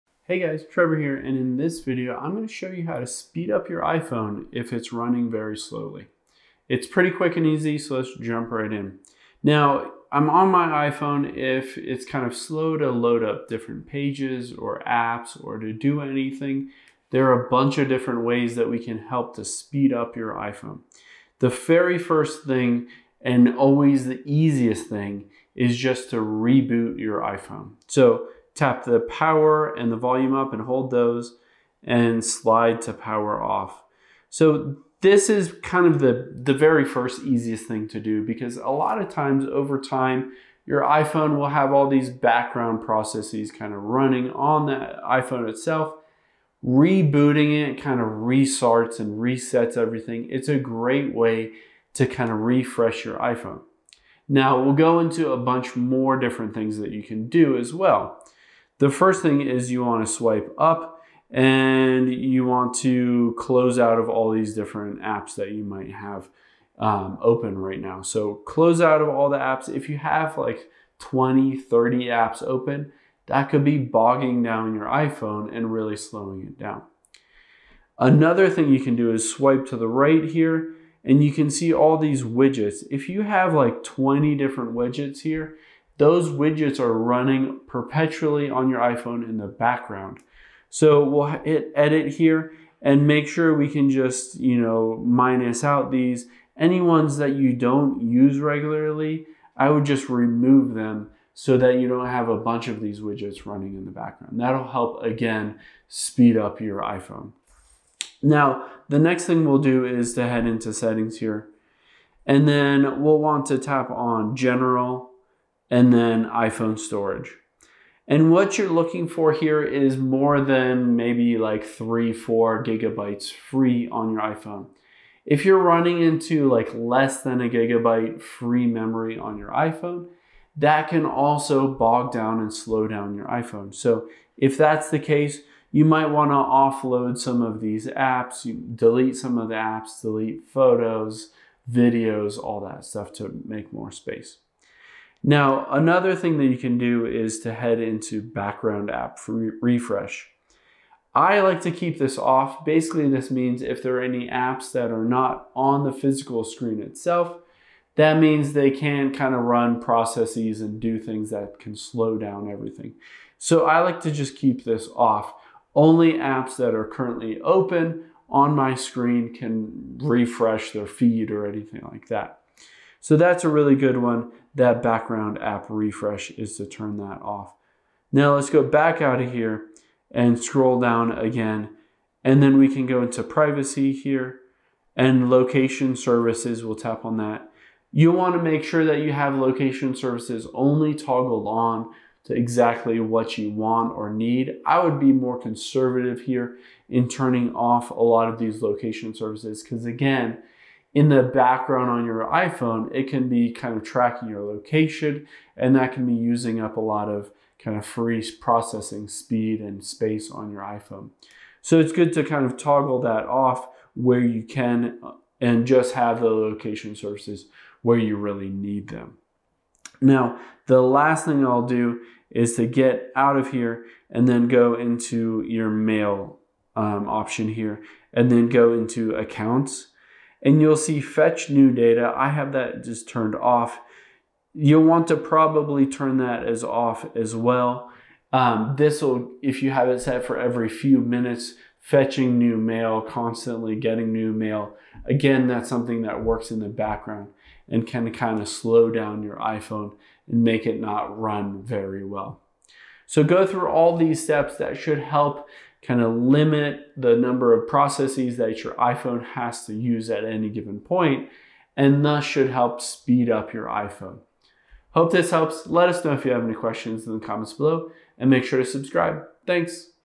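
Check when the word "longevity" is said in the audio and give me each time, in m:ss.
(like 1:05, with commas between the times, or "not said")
not said.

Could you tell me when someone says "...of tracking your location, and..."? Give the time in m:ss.
3:23.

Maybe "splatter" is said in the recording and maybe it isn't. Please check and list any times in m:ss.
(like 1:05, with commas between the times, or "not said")
not said.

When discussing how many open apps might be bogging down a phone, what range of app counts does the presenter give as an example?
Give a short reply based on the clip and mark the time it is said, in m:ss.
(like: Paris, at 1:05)
20, 30, at 1:10.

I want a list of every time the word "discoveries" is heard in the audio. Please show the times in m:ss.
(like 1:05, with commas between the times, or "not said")
not said.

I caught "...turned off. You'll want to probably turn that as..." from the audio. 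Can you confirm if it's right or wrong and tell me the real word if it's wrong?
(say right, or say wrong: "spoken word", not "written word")
right.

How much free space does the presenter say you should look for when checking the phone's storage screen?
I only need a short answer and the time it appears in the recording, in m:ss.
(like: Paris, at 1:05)
3-4 gigabytes, at 2:01.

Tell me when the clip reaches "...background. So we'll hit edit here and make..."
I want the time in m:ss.
1:29.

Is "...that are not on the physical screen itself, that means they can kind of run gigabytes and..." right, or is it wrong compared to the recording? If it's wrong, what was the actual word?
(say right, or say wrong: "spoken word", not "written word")
wrong: "processes", not "gigabytes".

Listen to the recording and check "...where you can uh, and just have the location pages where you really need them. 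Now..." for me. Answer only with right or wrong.
wrong.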